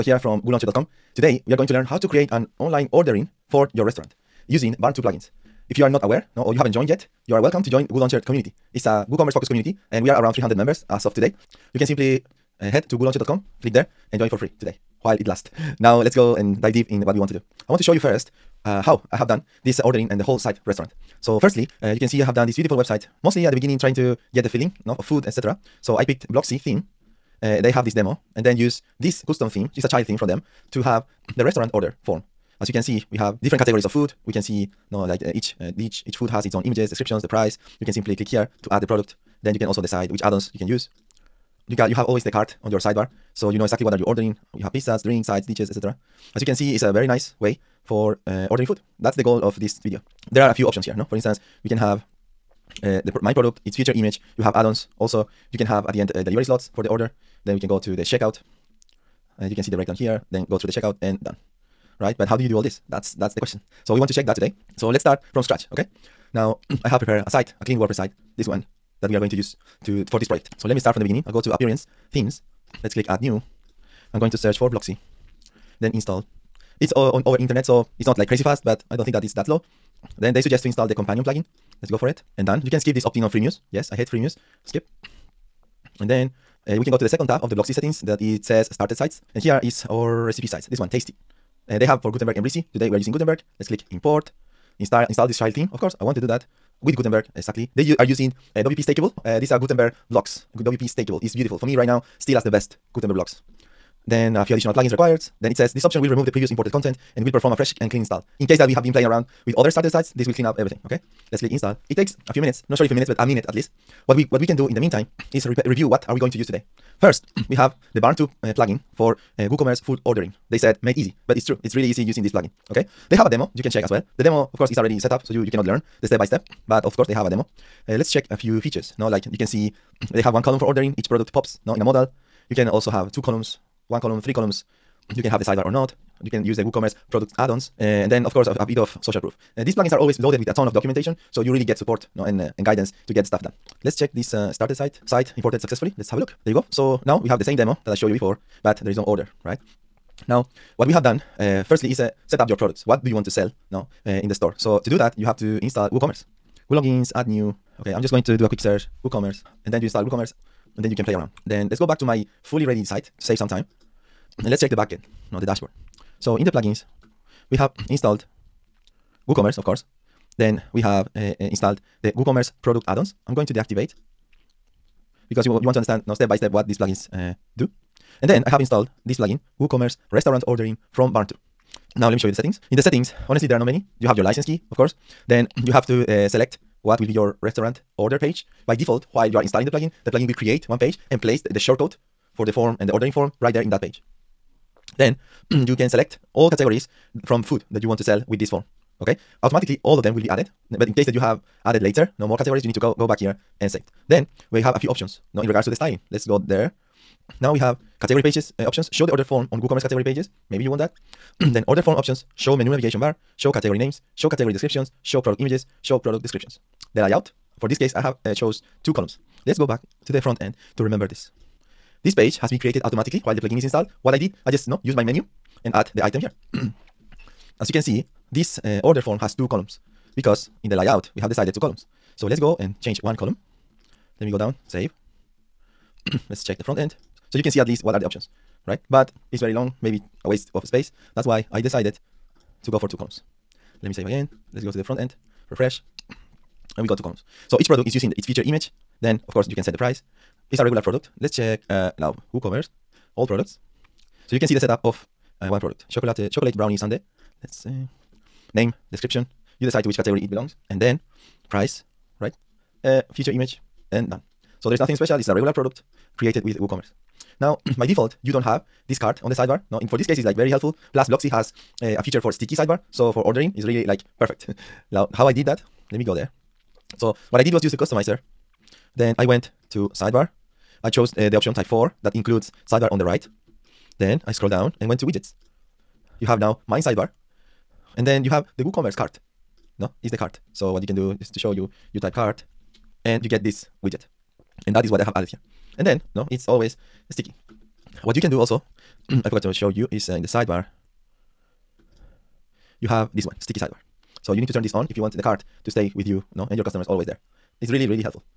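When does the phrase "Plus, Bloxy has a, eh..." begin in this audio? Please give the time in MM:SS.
04:30.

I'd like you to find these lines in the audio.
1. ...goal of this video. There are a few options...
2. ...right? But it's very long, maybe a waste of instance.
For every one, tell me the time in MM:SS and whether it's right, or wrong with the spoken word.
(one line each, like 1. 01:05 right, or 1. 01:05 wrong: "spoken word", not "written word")
1. 00:49 right
2. 03:58 wrong: "space", not "instance".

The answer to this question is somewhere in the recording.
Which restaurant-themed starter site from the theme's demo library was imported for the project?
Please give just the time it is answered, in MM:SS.
01:30.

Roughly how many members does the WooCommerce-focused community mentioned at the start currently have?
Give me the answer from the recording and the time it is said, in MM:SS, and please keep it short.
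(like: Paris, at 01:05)
300, at 00:10.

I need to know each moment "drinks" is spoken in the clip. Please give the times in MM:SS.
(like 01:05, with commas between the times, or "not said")
00:45.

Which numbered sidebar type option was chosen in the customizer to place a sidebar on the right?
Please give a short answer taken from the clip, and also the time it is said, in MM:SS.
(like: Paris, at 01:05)
Type 4, at 04:41.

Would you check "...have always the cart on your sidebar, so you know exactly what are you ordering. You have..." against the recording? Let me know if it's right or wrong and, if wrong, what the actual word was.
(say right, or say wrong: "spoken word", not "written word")
right.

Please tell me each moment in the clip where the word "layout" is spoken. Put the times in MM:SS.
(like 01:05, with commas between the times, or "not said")
03:37, 03:50.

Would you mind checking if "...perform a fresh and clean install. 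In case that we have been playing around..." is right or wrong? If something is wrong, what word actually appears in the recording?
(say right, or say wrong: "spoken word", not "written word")
right.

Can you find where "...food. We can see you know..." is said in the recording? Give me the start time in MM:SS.
00:33.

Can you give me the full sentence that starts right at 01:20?
Then they suggest to install the companion plugin.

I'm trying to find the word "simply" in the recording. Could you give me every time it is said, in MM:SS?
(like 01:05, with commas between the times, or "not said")
00:11, 00:37.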